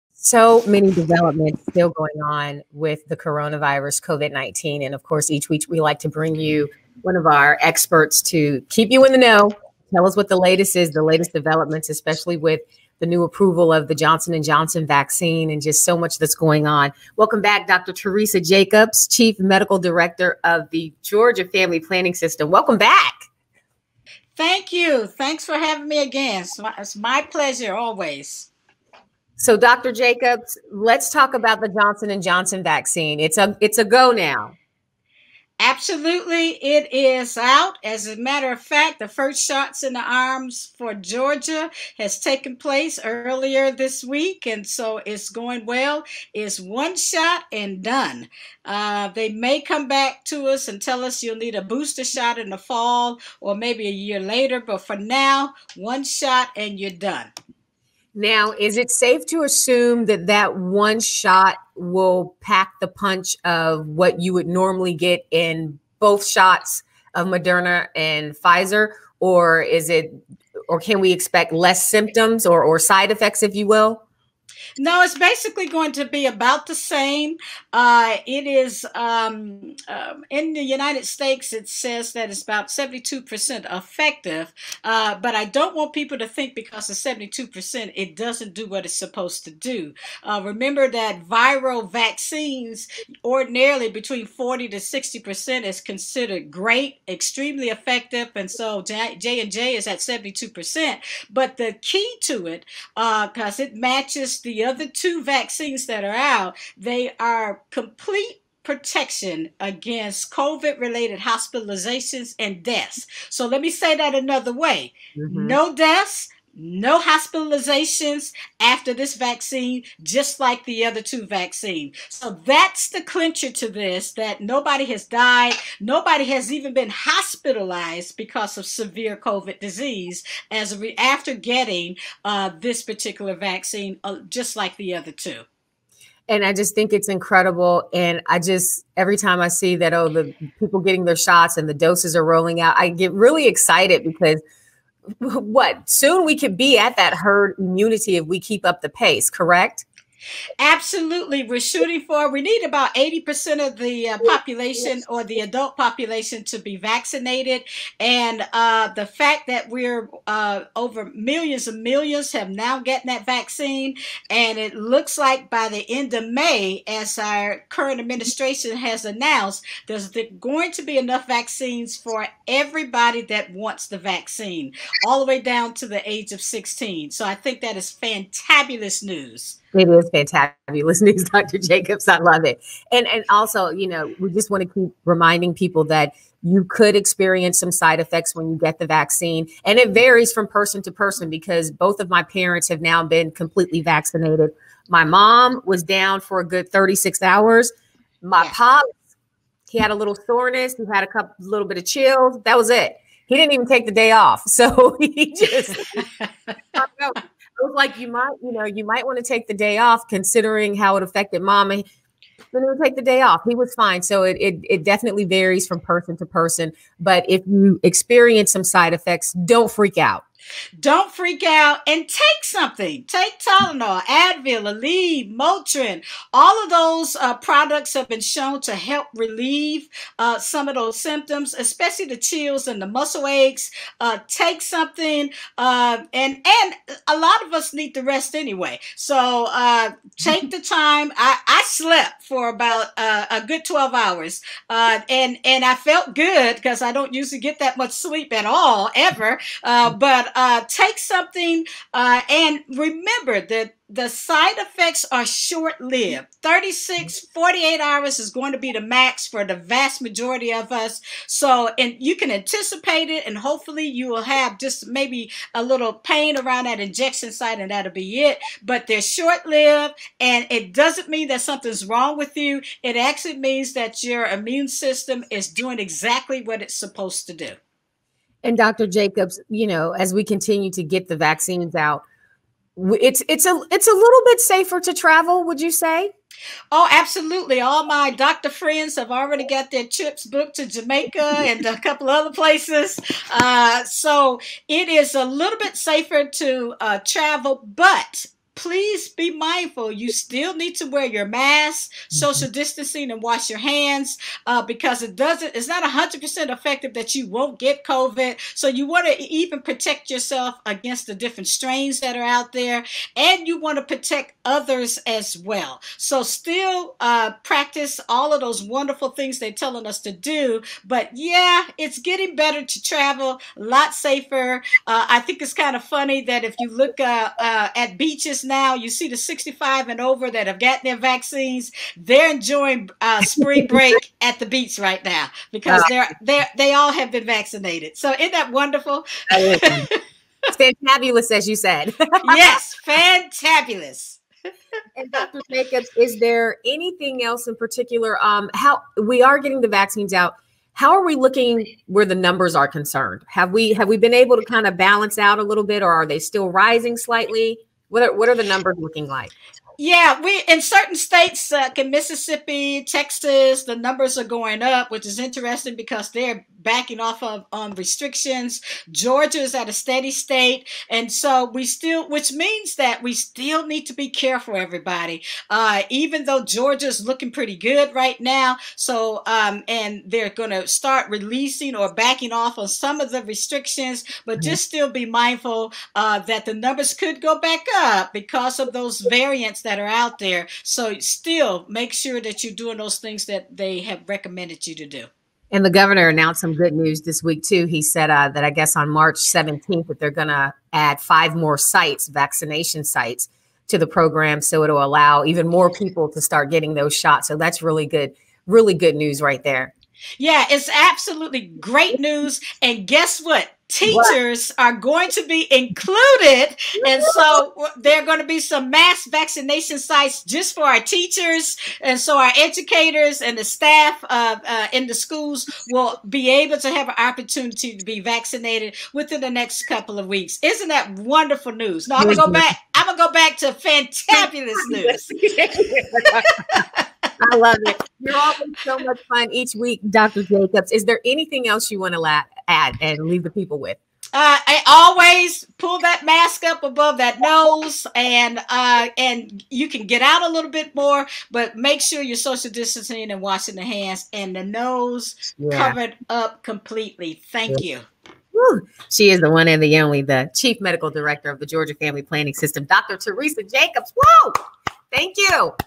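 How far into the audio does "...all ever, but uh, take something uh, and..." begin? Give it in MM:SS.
04:08.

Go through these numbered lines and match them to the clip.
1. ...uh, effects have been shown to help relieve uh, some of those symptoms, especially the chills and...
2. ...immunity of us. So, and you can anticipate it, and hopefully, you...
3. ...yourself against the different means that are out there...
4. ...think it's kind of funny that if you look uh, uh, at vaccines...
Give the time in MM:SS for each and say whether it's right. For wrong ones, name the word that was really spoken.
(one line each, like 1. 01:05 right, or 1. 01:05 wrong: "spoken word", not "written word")
1. 03:47 wrong: "products", not "effects"
2. 04:20 wrong: "majority", not "immunity"
3. 05:10 wrong: "strains", not "means"
4. 05:25 wrong: "beaches", not "vaccines".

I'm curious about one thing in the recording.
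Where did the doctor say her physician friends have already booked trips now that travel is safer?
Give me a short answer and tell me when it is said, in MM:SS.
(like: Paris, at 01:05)
Jamaica, at 04:50.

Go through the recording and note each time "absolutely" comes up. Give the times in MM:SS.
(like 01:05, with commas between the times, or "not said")
00:35, 02:30, 04:46, 06:50.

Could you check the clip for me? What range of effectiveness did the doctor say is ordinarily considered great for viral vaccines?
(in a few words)
40 to 60%.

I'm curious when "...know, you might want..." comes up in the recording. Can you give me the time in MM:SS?
03:28.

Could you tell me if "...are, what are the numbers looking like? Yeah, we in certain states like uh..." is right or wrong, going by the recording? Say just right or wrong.
right.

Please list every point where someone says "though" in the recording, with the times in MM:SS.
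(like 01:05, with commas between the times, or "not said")
06:16.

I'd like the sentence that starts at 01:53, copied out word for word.
So let me say that another way mm-hmm.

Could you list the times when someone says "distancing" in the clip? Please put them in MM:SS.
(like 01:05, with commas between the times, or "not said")
05:02, 07:32.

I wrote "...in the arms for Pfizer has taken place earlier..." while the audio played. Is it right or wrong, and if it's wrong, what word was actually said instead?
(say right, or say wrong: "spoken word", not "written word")
wrong: "Georgia", not "Pfizer".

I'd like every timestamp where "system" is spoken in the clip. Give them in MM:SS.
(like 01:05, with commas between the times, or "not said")
00:22, 04:34, 07:42.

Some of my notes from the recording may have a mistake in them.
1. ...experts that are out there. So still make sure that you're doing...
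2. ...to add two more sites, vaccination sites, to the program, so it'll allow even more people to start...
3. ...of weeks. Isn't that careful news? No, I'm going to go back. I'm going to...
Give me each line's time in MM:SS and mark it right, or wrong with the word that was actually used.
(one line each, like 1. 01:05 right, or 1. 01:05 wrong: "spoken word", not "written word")
1. 06:29 wrong: "variants", not "experts"
2. 06:40 wrong: "five", not "two"
3. 07:09 wrong: "wonderful", not "careful".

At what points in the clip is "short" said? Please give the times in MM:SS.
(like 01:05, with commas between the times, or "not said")
04:15, 04:29.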